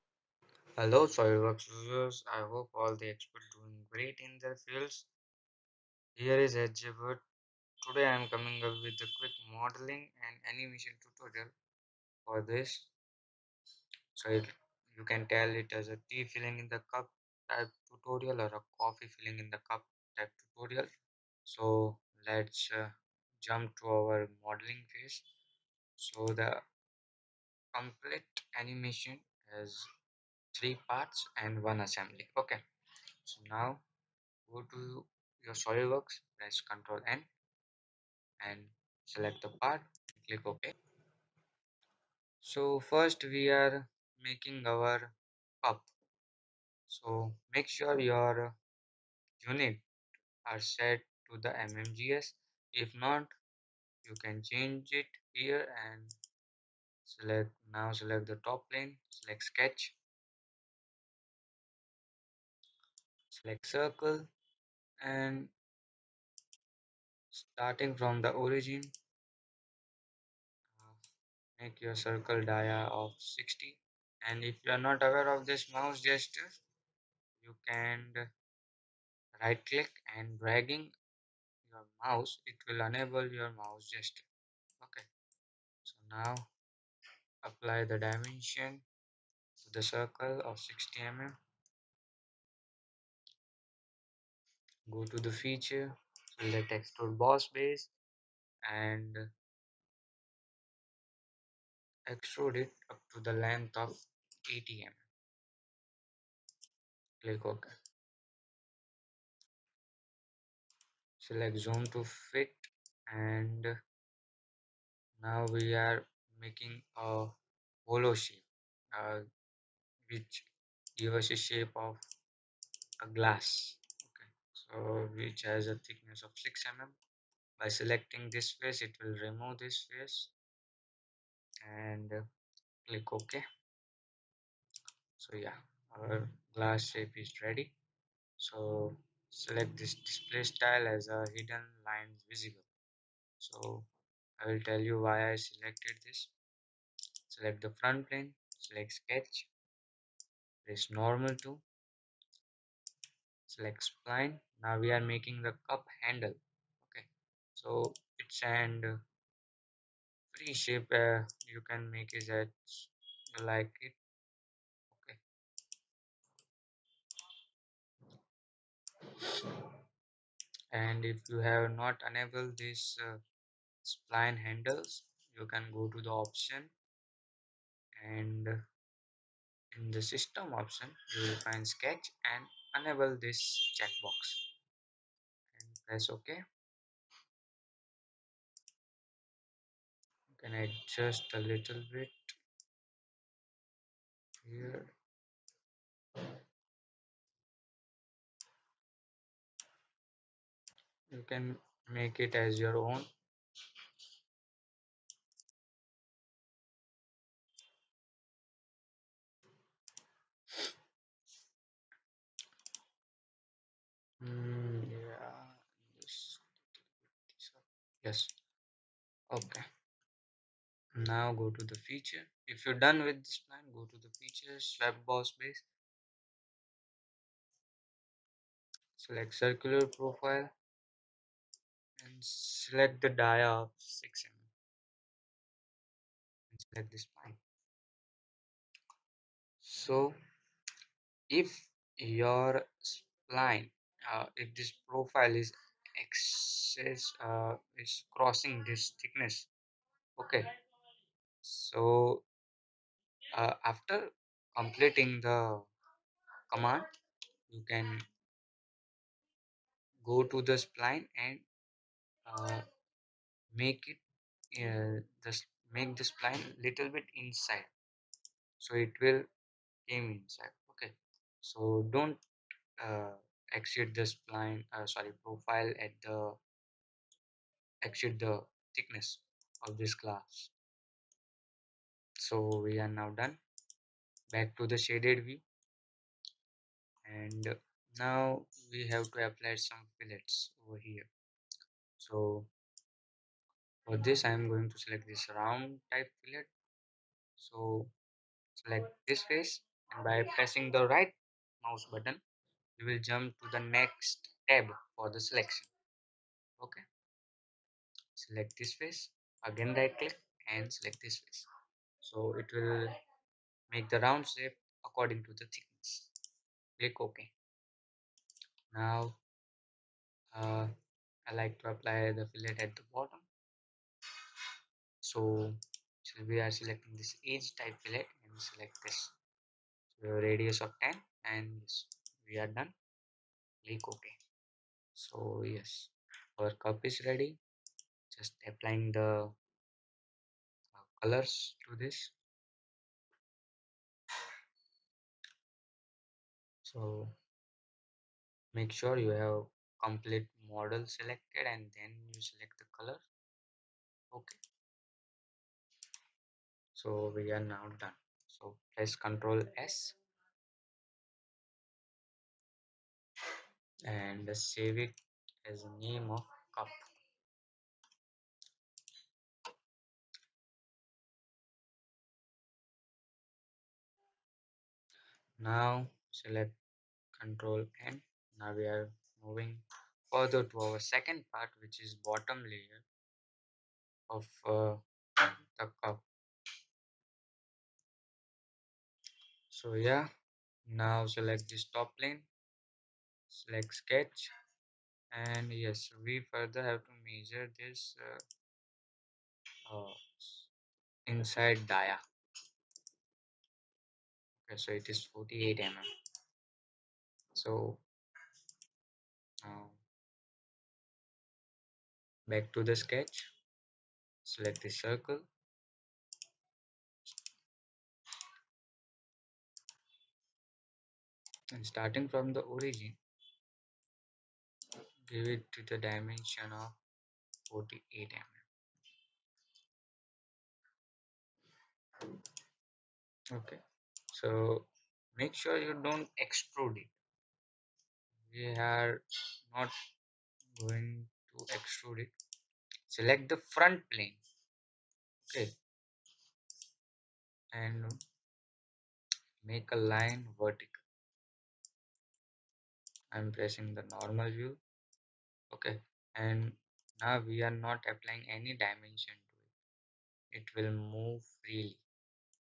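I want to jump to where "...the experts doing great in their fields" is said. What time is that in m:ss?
0:02.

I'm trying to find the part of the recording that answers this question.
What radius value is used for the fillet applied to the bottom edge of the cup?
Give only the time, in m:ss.
5:30.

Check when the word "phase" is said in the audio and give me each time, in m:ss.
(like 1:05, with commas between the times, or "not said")
0:24.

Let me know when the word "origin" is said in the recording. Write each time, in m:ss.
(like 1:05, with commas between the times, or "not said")
1:08, 7:02.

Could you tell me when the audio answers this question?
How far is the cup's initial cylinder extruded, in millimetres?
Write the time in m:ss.
1:44.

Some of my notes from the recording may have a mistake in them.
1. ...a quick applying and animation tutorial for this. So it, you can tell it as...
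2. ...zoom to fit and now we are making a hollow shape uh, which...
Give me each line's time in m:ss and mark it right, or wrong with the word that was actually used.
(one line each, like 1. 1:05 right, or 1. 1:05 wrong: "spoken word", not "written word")
1. 0:09 wrong: "modeling", not "applying"
2. 1:51 right.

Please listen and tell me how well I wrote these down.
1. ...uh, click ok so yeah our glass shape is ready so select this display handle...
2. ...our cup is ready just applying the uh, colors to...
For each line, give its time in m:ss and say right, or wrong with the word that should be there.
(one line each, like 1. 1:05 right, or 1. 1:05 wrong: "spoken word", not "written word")
1. 2:12 wrong: "style", not "handle"
2. 5:36 right.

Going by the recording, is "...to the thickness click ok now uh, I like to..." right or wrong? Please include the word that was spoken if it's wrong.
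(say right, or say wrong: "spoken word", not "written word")
right.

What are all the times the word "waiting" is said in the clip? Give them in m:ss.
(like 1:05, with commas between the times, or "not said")
not said.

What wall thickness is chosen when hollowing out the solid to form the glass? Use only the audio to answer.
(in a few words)
6 mm.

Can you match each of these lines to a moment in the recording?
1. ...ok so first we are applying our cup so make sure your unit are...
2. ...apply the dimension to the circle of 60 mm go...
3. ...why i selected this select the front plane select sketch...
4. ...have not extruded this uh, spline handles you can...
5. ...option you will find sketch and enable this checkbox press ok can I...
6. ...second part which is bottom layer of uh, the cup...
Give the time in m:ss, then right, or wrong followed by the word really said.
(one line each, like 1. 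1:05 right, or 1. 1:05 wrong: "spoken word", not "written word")
1. 0:40 wrong: "making", not "applying"
2. 1:27 right
3. 2:25 right
4. 2:51 wrong: "enabled", not "extruded"
5. 3:00 right
6. 6:20 right.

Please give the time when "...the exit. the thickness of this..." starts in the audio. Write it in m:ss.
4:36.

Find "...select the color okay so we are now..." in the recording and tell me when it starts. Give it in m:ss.
5:52.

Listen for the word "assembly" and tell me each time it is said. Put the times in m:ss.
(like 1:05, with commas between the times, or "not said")
0:31.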